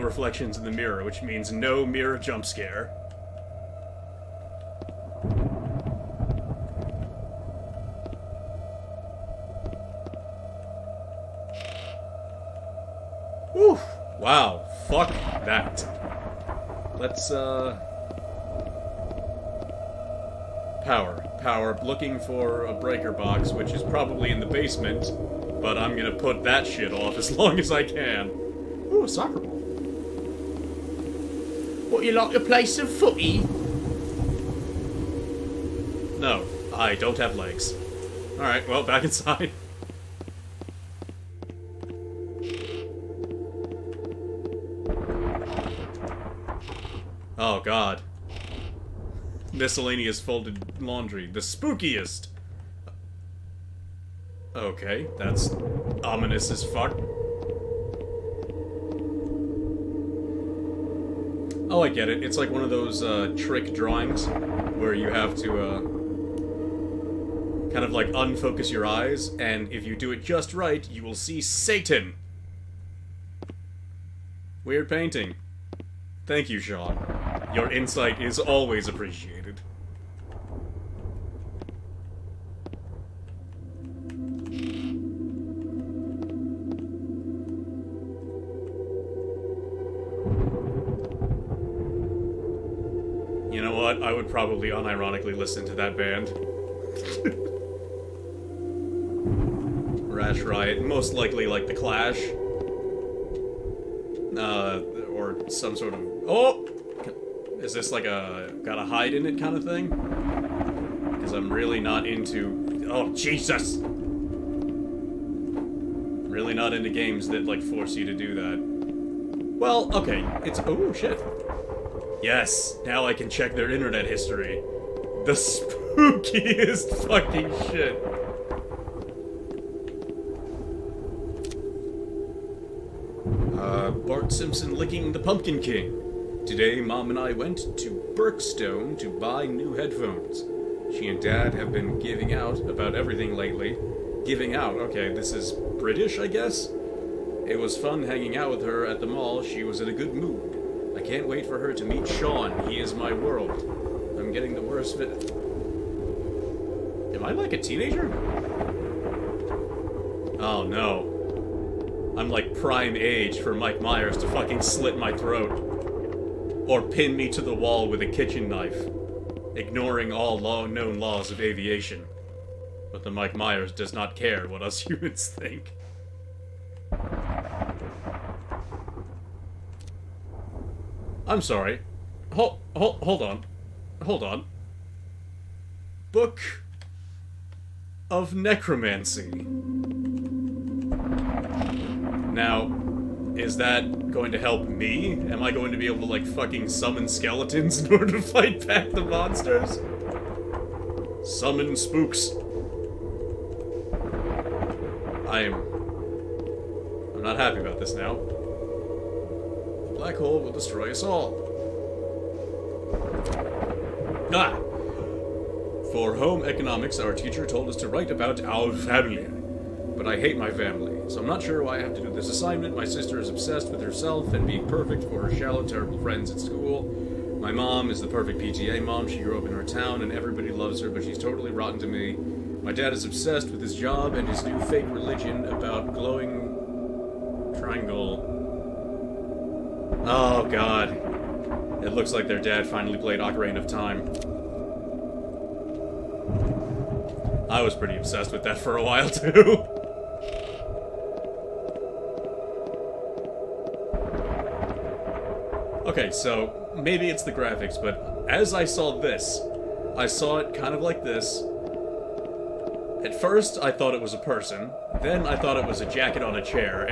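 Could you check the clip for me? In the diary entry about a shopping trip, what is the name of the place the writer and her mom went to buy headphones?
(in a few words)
Berkstone.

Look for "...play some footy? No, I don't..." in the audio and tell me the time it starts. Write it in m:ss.
0:32.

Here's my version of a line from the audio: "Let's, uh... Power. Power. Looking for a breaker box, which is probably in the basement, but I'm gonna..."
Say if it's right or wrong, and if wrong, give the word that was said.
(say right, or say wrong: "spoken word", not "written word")
right.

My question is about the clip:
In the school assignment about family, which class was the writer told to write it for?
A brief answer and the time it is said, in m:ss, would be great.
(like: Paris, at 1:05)
Home economics, at 3:36.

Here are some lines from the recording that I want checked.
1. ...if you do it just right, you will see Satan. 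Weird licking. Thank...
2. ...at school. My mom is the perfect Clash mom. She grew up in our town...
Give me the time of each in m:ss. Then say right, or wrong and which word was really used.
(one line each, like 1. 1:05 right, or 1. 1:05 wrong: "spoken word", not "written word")
1. 1:09 wrong: "painting", not "licking"
2. 3:46 wrong: "PTA", not "Clash".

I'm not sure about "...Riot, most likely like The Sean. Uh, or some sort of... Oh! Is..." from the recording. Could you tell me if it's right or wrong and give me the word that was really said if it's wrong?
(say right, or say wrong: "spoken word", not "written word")
wrong: "Clash", not "Sean".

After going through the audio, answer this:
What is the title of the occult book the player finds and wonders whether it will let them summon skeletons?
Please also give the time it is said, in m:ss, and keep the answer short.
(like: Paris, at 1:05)
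Book of Necromancy, at 3:06.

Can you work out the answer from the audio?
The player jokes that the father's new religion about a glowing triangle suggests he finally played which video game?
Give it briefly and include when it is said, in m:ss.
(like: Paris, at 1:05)
Ocarina of Time, at 4:03.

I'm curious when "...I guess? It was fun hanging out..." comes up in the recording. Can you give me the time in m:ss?
2:26.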